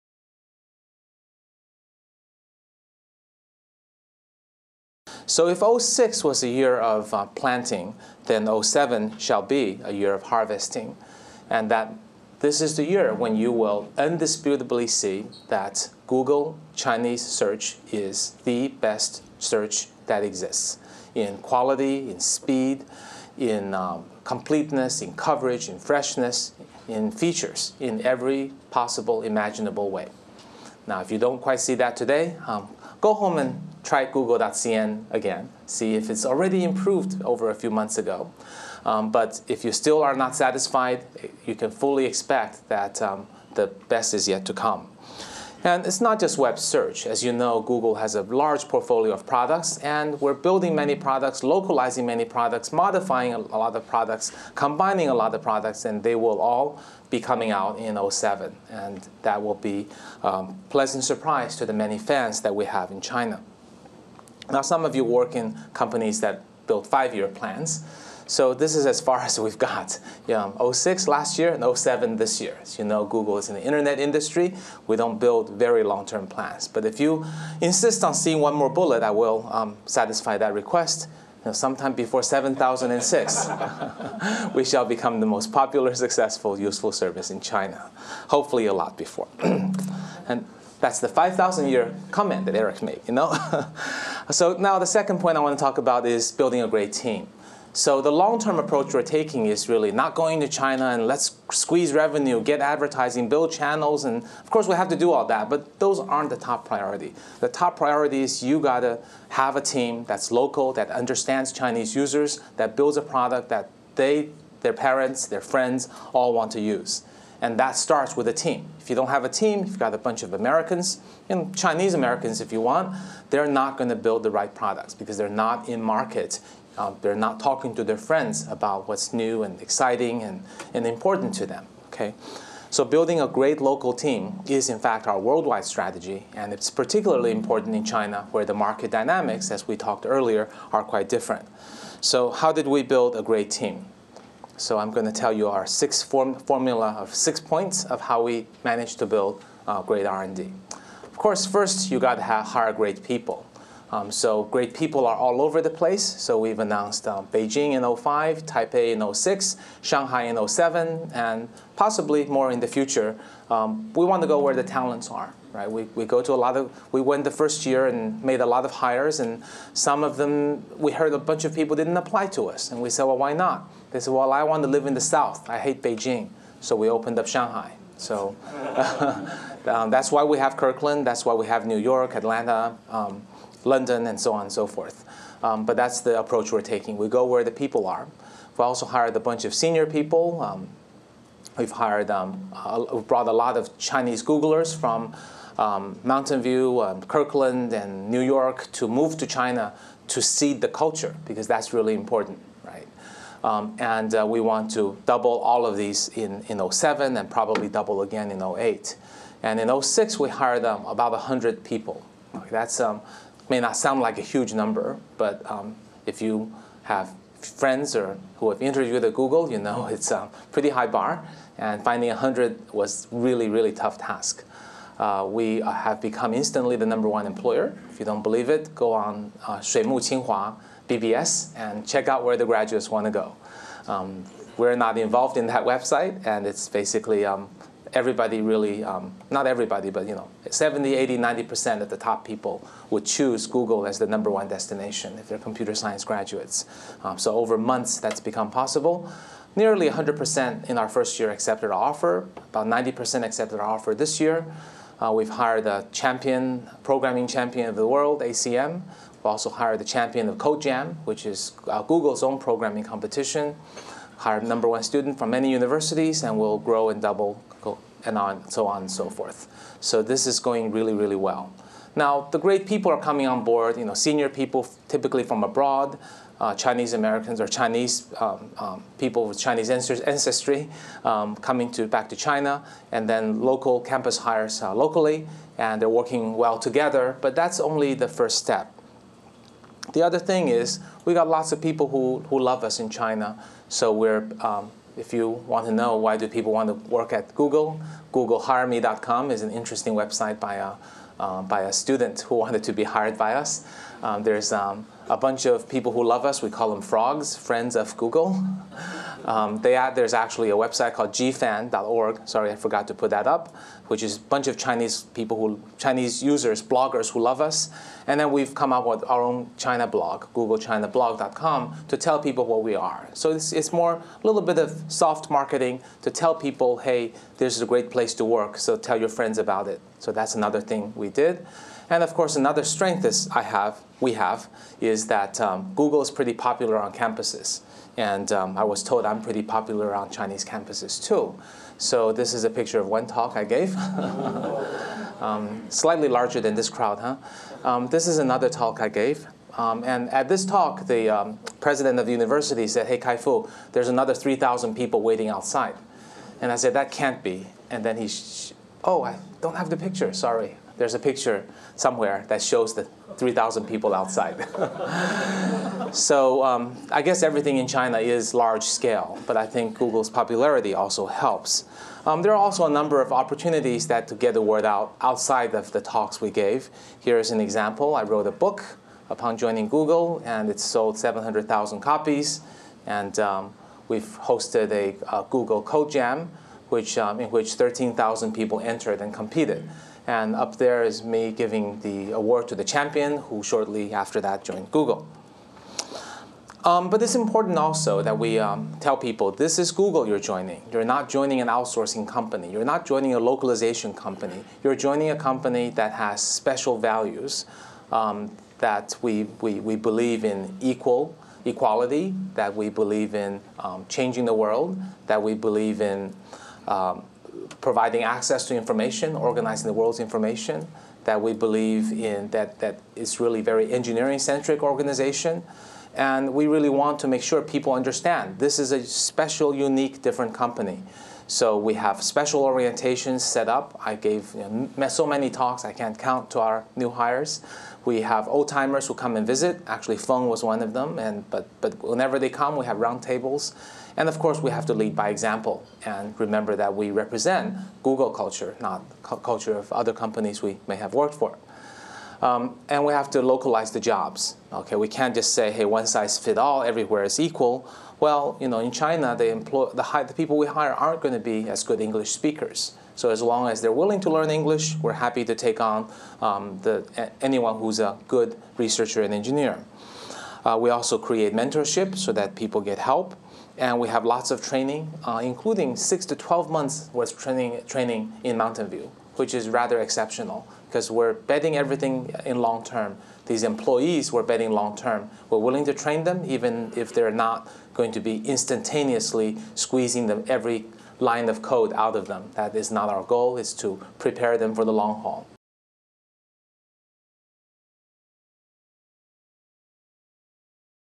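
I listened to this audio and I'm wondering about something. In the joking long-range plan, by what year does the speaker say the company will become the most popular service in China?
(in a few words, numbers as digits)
7006.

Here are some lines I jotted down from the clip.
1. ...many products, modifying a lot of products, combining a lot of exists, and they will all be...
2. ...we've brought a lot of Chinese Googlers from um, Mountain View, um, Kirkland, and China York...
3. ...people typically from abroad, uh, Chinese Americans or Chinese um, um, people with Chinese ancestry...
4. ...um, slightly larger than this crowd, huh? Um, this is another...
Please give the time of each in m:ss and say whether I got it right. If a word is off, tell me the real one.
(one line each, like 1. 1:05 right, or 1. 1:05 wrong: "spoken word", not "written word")
1. 0:52 wrong: "products", not "exists"
2. 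3:12 wrong: "New", not "China"
3. 4:34 right
4. 5:45 right.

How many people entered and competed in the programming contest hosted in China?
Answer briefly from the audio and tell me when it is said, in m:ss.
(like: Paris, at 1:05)
13,000, at 6:27.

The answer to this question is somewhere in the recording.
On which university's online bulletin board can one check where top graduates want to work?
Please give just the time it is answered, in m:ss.
3:49.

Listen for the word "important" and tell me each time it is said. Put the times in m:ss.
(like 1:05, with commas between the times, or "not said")
2:10, 2:17, 3:21, 6:37.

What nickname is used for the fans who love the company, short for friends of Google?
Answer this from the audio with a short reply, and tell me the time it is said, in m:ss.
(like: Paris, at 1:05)
frogs, at 5:06.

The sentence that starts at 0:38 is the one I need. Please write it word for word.
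Um, but if you still are not satisfied, you can fully expect that um, the best is yet to come.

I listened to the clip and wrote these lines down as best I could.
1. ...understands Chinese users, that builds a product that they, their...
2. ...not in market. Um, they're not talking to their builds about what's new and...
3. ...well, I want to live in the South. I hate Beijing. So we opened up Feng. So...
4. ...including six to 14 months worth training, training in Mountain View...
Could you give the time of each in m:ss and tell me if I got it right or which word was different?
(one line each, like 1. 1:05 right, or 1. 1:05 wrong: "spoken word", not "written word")
1. 1:50 right
2. 2:05 wrong: "friends", not "builds"
3. 2:54 wrong: "Shanghai", not "Feng"
4. 7:55 wrong: "12", not "14".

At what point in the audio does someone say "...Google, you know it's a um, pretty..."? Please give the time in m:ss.
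3:39.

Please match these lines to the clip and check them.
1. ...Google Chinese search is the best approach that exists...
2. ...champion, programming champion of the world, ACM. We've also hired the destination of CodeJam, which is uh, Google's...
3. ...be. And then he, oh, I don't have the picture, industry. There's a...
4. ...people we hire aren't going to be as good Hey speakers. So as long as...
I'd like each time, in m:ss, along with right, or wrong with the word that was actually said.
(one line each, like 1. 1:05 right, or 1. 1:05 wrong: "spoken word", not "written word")
1. 0:16 wrong: "search", not "approach"
2. 4:15 wrong: "champion", not "destination"
3. 5:57 wrong: "sorry", not "industry"
4. 7:40 wrong: "English", not "Hey".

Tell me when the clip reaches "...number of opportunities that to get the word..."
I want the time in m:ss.
6:12.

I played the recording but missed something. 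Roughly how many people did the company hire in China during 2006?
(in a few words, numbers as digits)
about 100.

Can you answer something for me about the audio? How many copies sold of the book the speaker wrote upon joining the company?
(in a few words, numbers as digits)
700,000.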